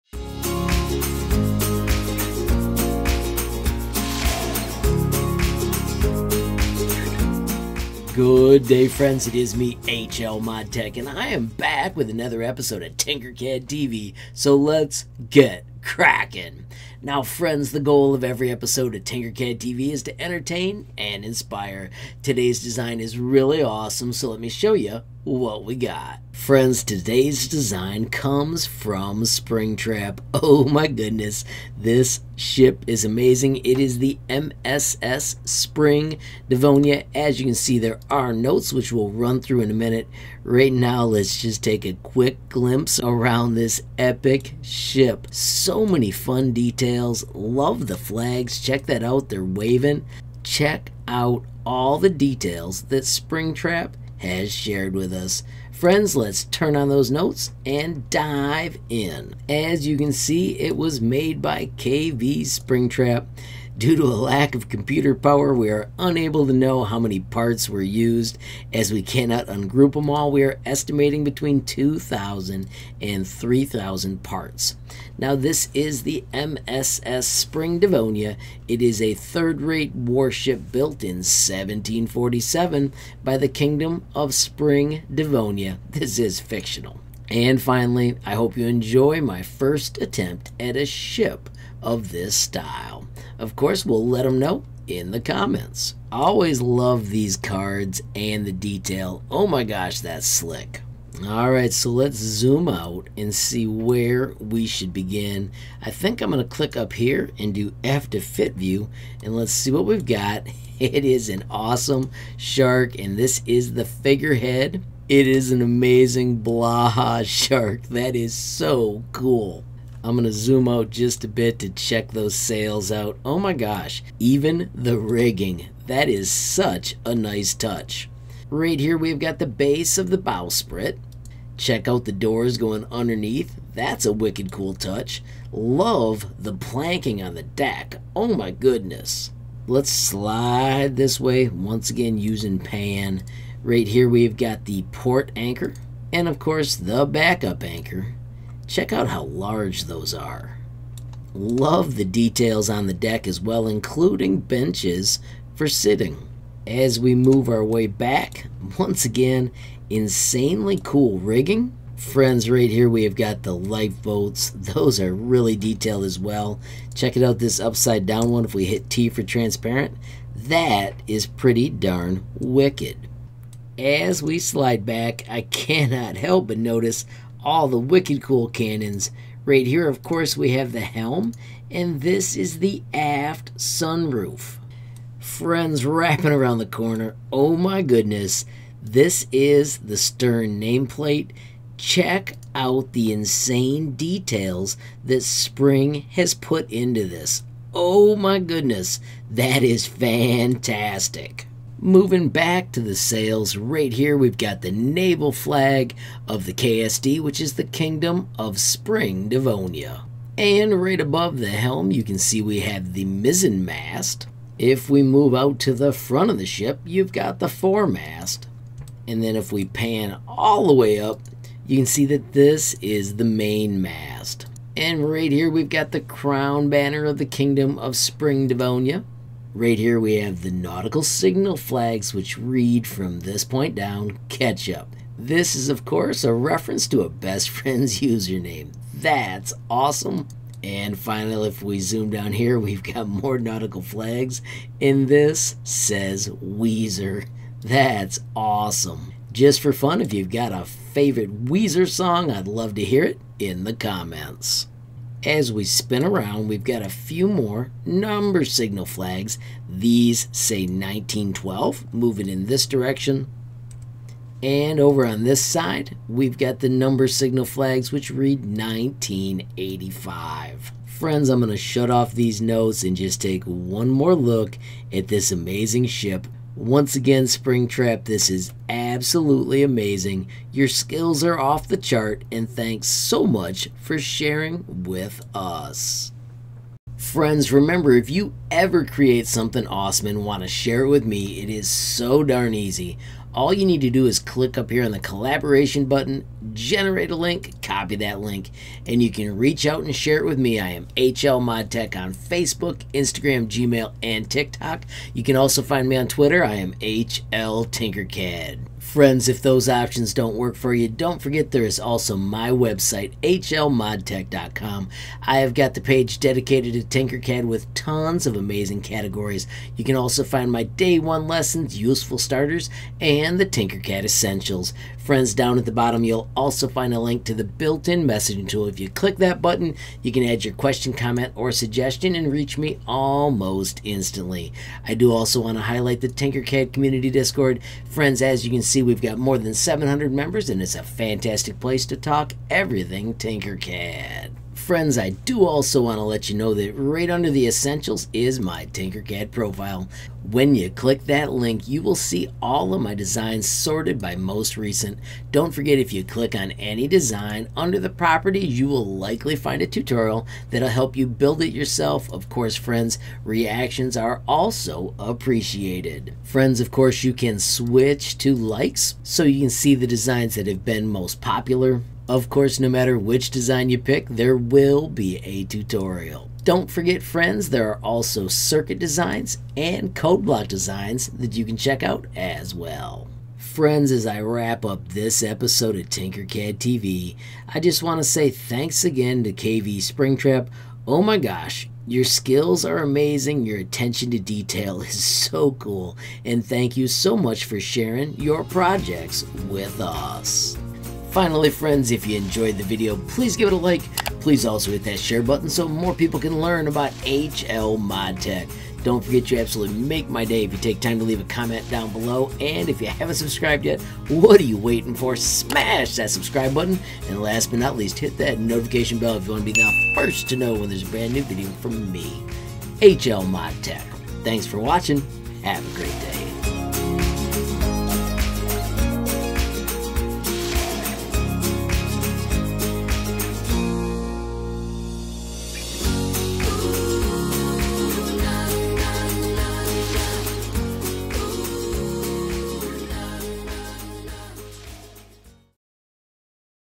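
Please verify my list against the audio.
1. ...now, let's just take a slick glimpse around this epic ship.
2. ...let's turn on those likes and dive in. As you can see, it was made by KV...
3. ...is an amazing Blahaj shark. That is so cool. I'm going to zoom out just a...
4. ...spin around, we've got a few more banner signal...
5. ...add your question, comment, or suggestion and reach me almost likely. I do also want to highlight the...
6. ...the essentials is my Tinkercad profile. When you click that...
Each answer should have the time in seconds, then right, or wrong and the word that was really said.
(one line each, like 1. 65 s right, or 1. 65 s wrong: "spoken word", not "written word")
1. 40 s wrong: "quick", not "slick"
2. 56 s wrong: "notes", not "likes"
3. 115 s right
4. 255 s wrong: "number", not "banner"
5. 330 s wrong: "instantly", not "likely"
6. 347 s right.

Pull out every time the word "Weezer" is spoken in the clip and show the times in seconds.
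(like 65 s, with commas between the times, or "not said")
246 s, 251 s.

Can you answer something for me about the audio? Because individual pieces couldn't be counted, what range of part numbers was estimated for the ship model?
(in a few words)
2,000 to 3,000.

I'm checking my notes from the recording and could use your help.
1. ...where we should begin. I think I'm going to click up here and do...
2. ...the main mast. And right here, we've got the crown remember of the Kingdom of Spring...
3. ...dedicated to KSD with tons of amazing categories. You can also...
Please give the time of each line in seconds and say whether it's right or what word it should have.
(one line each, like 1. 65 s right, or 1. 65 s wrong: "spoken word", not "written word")
1. 103 s right
2. 223 s wrong: "banner", not "remember"
3. 316 s wrong: "Tinkercad", not "KSD".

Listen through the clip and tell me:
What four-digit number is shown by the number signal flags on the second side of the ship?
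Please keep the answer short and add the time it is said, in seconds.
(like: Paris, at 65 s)
1985, at 268 s.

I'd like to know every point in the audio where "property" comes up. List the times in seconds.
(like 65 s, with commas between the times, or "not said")
357 s.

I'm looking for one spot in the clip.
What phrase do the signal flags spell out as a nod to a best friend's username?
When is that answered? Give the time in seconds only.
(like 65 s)
234 s.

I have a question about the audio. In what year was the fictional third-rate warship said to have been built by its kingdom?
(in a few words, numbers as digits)
1747.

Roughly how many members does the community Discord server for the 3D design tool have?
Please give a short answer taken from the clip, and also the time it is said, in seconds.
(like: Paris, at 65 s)
More than 700, at 339 s.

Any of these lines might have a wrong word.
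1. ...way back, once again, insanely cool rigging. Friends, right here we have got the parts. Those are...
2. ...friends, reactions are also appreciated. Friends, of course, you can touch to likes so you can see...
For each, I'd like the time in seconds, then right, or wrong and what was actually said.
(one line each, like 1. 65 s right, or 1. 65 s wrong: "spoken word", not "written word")
1. 157 s wrong: "lifeboats", not "parts"
2. 362 s wrong: "switch", not "touch".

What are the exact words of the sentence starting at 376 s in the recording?
Don't forget, friends, there are also circuit designs and code block designs that you can check out as well.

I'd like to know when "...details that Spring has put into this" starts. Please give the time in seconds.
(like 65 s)
193 s.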